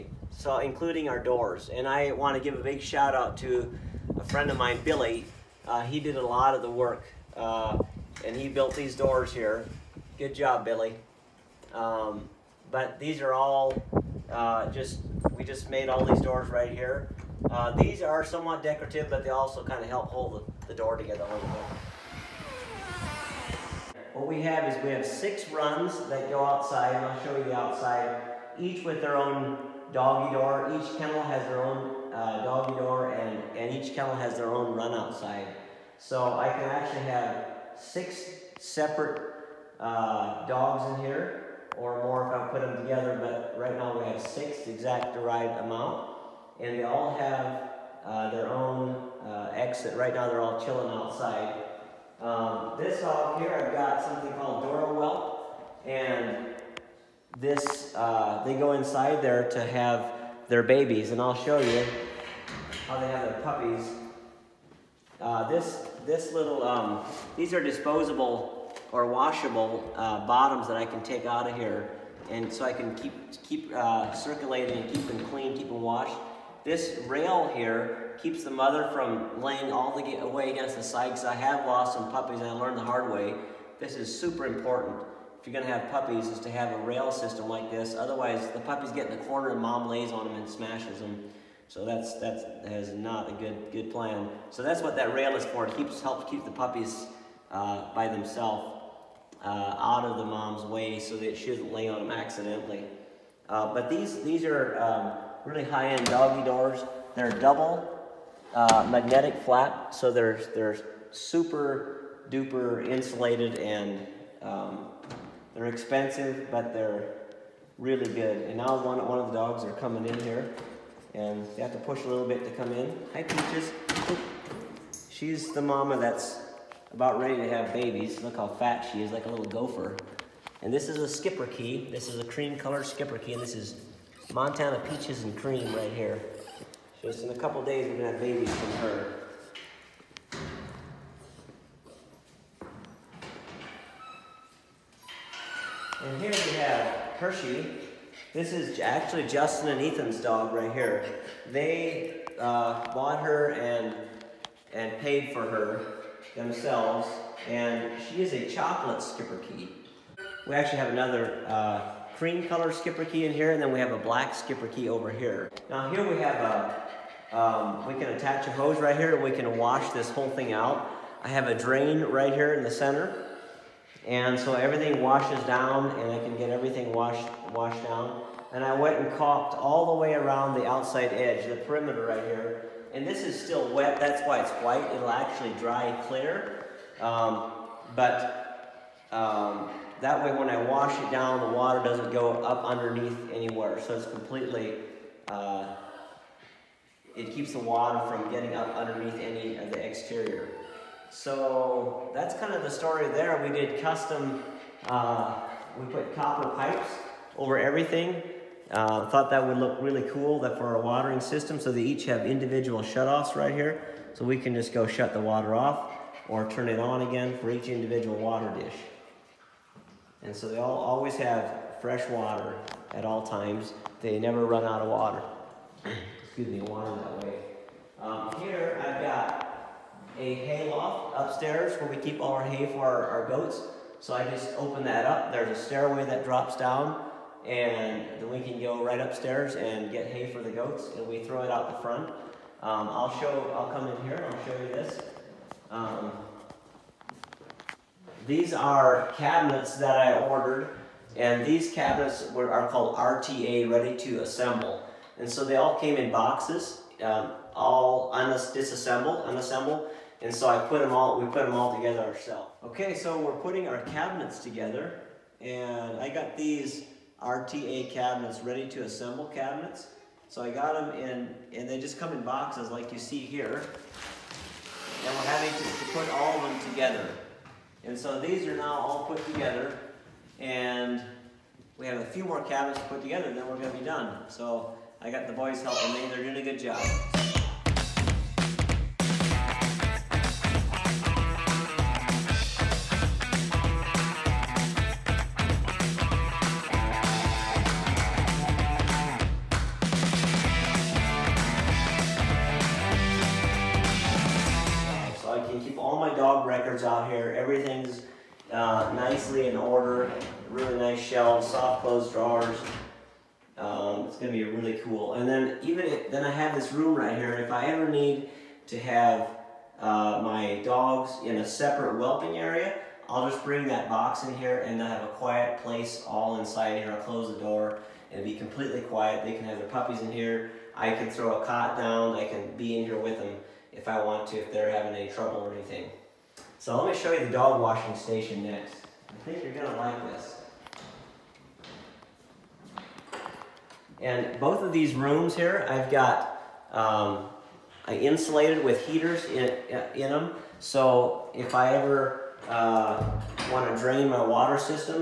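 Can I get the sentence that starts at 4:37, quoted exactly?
And so these are now all put together.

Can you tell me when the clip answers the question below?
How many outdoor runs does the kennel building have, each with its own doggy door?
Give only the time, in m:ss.
0:25.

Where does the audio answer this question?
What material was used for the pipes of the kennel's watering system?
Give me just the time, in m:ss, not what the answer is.
3:26.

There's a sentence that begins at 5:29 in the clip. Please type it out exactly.
They can have their puppies in here.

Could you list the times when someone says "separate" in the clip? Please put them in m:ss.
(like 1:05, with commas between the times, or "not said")
0:38, 5:21.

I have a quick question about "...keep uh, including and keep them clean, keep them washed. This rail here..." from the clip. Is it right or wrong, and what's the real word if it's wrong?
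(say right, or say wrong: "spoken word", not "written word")
wrong: "circulating", not "including".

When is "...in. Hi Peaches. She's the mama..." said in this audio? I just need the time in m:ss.
2:02.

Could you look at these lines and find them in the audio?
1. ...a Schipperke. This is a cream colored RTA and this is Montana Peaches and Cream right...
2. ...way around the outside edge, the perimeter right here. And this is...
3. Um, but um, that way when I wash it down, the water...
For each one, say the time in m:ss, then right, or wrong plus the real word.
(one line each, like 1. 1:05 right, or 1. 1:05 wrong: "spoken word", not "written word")
1. 2:10 wrong: "Schipperke", not "RTA"
2. 3:00 right
3. 3:07 right.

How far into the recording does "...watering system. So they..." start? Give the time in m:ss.
3:30.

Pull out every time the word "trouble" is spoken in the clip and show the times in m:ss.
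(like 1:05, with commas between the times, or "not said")
5:35.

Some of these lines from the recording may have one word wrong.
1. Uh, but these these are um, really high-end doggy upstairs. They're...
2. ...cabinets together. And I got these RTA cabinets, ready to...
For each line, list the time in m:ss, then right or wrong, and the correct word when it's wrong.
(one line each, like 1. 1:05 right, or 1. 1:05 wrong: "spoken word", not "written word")
1. 1:43 wrong: "doors", not "upstairs"
2. 4:23 right.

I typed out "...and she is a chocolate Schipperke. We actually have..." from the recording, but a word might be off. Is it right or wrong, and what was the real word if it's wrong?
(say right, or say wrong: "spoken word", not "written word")
right.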